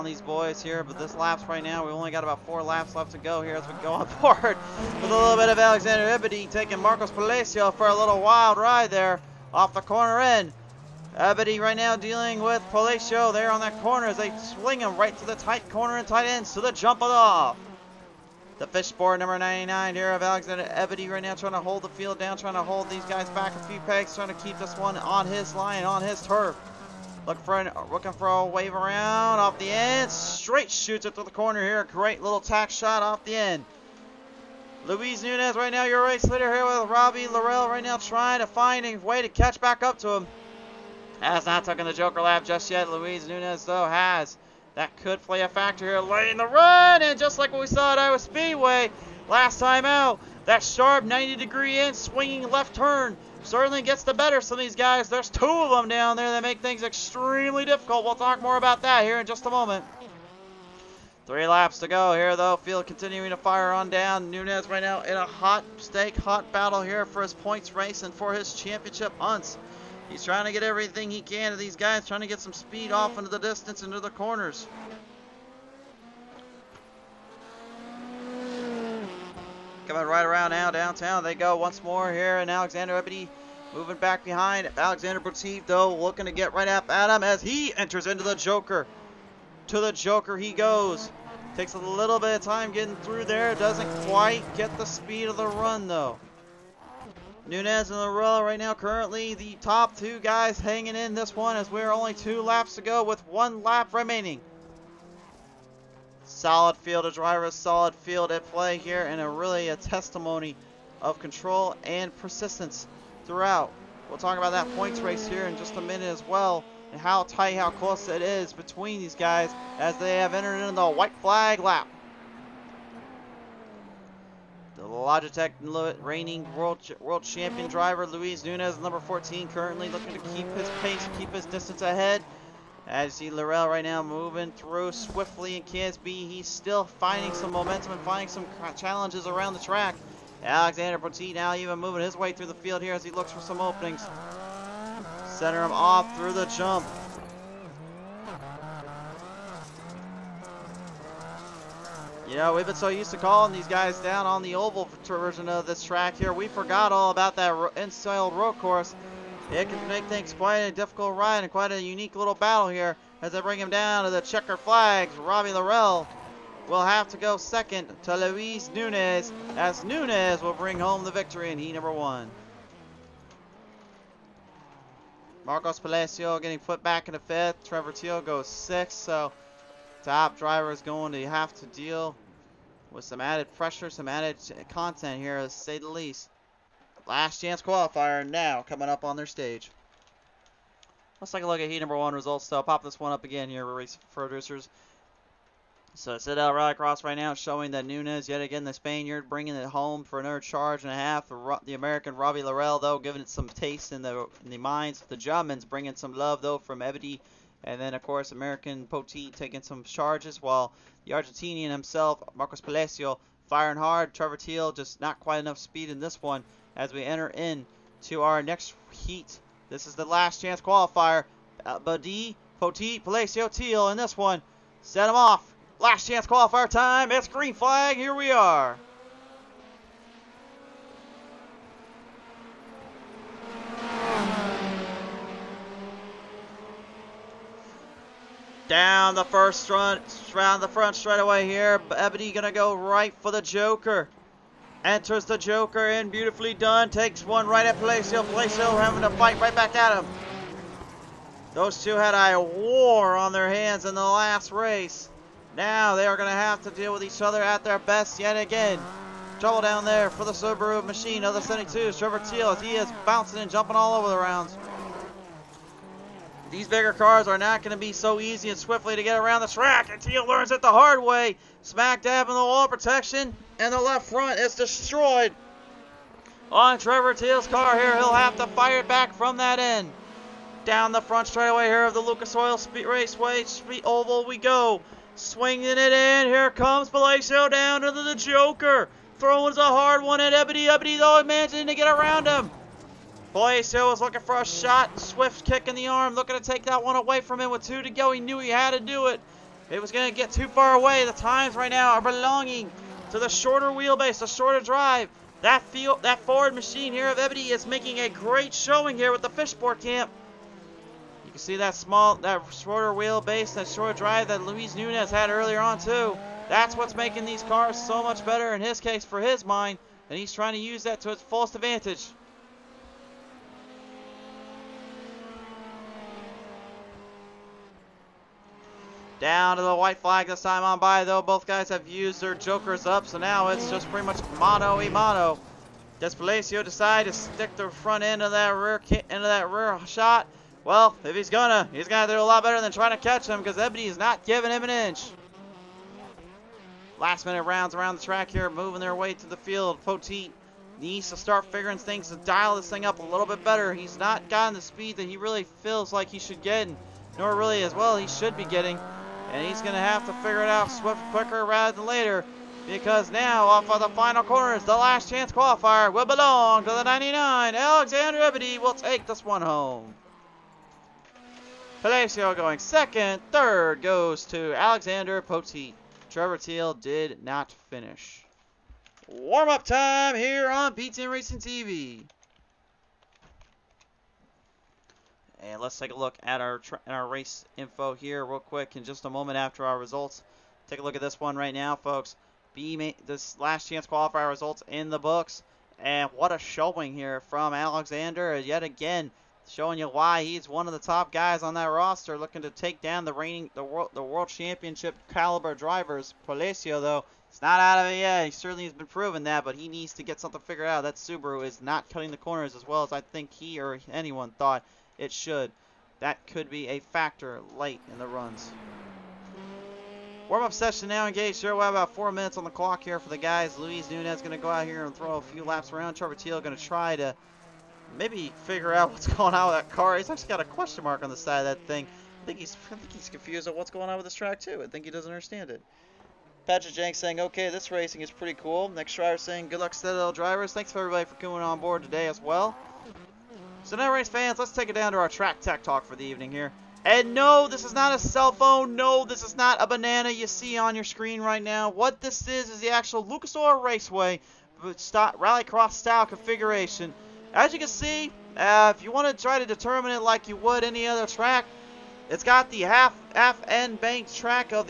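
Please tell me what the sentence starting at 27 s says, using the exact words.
Looking for, an, looking for a wave around off the end.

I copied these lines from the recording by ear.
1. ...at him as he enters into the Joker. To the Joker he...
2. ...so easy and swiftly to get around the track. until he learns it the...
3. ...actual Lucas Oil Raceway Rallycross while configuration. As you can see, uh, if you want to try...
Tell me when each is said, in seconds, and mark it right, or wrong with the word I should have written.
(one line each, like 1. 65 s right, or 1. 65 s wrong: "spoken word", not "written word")
1. 86 s right
2. 267 s right
3. 452 s wrong: "style", not "while".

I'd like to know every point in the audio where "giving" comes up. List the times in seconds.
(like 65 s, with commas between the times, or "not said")
202 s, 344 s.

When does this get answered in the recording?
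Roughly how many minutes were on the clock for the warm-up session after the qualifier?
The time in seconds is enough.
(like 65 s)
421 s.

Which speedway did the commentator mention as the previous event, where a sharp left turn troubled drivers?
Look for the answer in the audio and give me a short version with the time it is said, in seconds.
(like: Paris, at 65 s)
Iowa Speedway, at 47 s.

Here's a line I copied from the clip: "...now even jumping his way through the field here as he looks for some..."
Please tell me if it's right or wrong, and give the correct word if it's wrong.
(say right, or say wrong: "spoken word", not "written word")
wrong: "moving", not "jumping".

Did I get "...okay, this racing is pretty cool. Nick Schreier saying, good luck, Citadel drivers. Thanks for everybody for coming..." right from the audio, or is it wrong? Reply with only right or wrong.
right.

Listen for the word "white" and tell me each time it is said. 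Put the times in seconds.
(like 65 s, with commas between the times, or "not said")
120 s, 329 s.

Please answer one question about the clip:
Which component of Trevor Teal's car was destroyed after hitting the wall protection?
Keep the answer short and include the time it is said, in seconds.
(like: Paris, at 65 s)
left front, at 273 s.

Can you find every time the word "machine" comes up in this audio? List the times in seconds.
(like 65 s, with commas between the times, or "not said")
260 s, 306 s.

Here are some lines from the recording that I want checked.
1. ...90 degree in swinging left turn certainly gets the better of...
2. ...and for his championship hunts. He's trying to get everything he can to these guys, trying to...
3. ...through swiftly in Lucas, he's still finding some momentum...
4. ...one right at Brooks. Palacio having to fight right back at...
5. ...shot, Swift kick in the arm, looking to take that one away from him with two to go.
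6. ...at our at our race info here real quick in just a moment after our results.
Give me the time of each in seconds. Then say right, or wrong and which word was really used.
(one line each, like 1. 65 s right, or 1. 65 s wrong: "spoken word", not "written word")
1. 51 s right
2. 68 s right
3. 134 s wrong: "KSB", not "Lucas"
4. 247 s wrong: "Palacio", not "Brooks"
5. 294 s right
6. 386 s right.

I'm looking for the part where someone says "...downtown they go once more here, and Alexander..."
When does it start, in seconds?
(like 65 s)
80 s.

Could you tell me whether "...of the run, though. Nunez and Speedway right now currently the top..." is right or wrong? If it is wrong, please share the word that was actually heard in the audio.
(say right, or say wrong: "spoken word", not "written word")
wrong: "Larella", not "Speedway".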